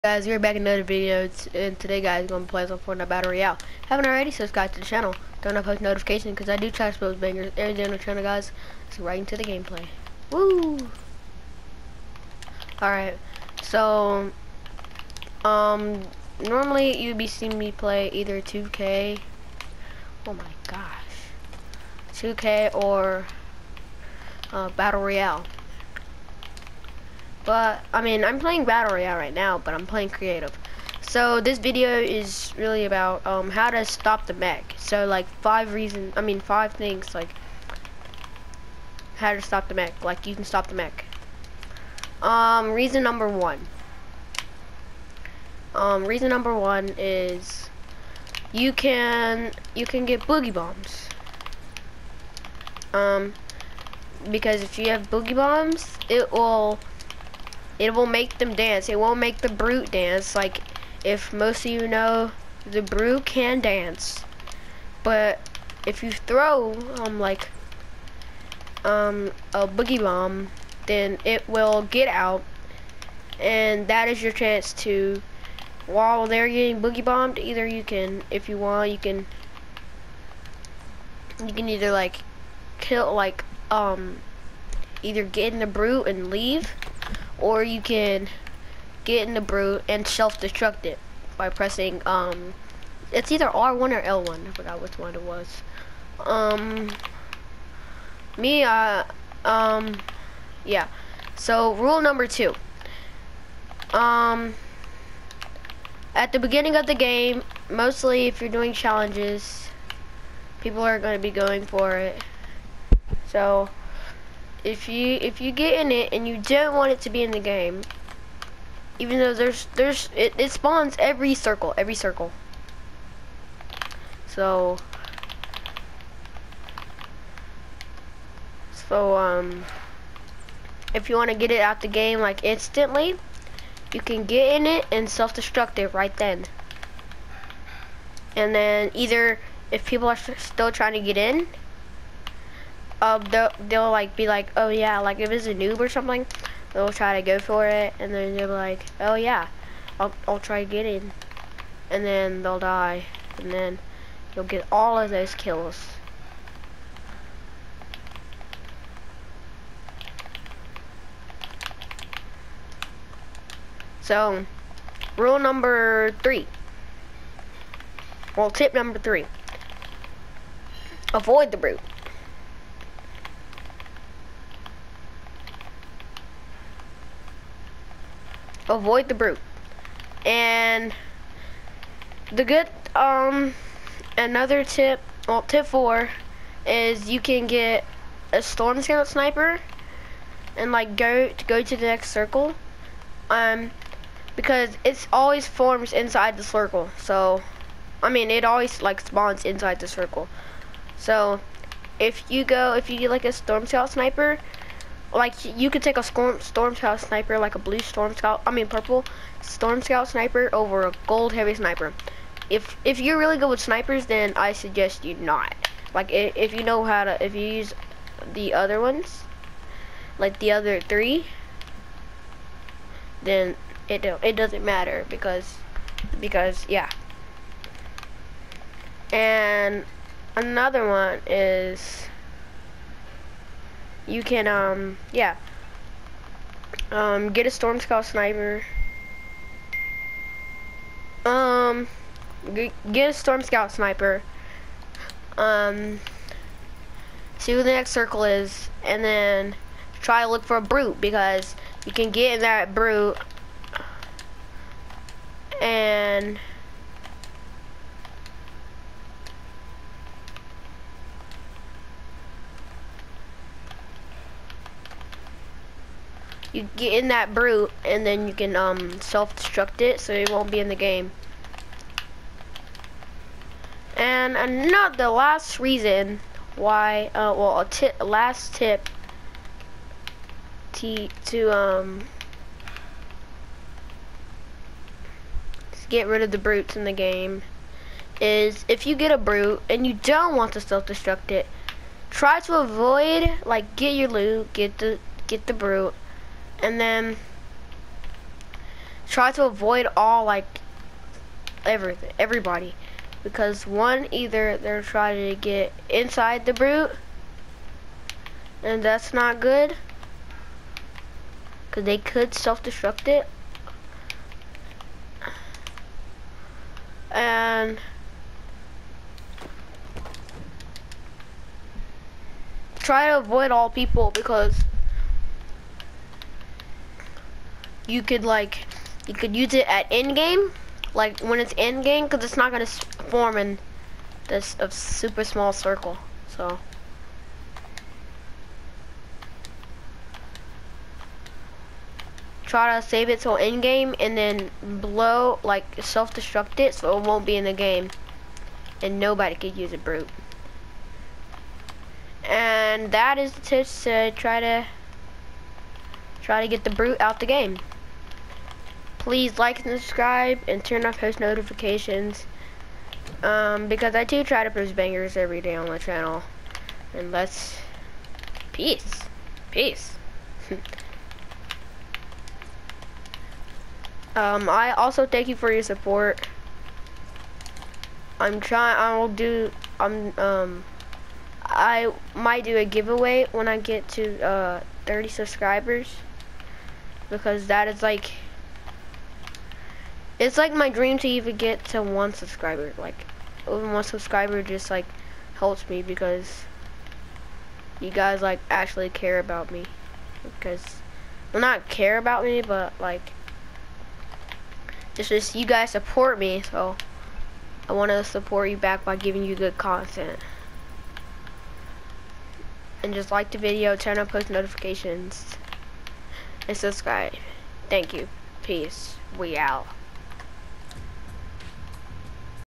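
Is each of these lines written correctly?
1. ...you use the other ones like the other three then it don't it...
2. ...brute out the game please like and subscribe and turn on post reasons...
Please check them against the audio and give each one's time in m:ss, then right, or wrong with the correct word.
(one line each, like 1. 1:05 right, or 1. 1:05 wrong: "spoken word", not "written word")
1. 3:37 right
2. 5:56 wrong: "notifications", not "reasons".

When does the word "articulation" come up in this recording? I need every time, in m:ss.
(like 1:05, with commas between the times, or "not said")
not said.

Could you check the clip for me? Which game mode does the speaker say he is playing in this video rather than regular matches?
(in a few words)
Creative.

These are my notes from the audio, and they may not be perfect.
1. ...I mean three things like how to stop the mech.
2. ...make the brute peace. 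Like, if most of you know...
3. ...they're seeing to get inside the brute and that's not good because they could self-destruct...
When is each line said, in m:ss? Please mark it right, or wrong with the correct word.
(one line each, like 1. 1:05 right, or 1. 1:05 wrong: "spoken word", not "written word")
1. 0:36 wrong: "five", not "three"
2. 0:59 wrong: "dance", not "peace"
3. 5:04 wrong: "trying", not "seeing".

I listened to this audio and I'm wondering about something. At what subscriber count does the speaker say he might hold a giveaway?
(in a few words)
30.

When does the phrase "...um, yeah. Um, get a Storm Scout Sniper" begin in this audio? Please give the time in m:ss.
3:54.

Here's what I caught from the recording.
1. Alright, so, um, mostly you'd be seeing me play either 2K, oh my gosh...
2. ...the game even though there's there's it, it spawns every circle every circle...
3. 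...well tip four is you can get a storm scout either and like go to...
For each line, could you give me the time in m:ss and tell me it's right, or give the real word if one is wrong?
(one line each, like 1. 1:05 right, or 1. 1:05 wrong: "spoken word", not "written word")
1. 0:12 wrong: "normally", not "mostly"
2. 1:57 right
3. 3:05 wrong: "sniper", not "either".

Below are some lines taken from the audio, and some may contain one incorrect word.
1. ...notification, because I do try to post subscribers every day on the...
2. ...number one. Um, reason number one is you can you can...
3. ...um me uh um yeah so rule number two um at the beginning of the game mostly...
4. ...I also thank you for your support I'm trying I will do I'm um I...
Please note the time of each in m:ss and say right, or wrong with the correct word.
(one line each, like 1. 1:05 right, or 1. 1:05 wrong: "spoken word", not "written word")
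1. 0:05 wrong: "bangers", not "subscribers"
2. 0:43 right
3. 1:36 right
4. 6:14 right.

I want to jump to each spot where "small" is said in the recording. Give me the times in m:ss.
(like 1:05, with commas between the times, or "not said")
5:35.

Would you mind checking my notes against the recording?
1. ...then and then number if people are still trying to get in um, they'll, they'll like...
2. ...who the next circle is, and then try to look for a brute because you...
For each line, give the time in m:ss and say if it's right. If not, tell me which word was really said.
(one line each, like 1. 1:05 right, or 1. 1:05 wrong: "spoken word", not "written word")
1. 2:16 wrong: "either", not "number"
2. 4:07 right.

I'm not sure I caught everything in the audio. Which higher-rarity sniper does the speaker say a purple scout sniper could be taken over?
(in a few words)
Gold heavy sniper.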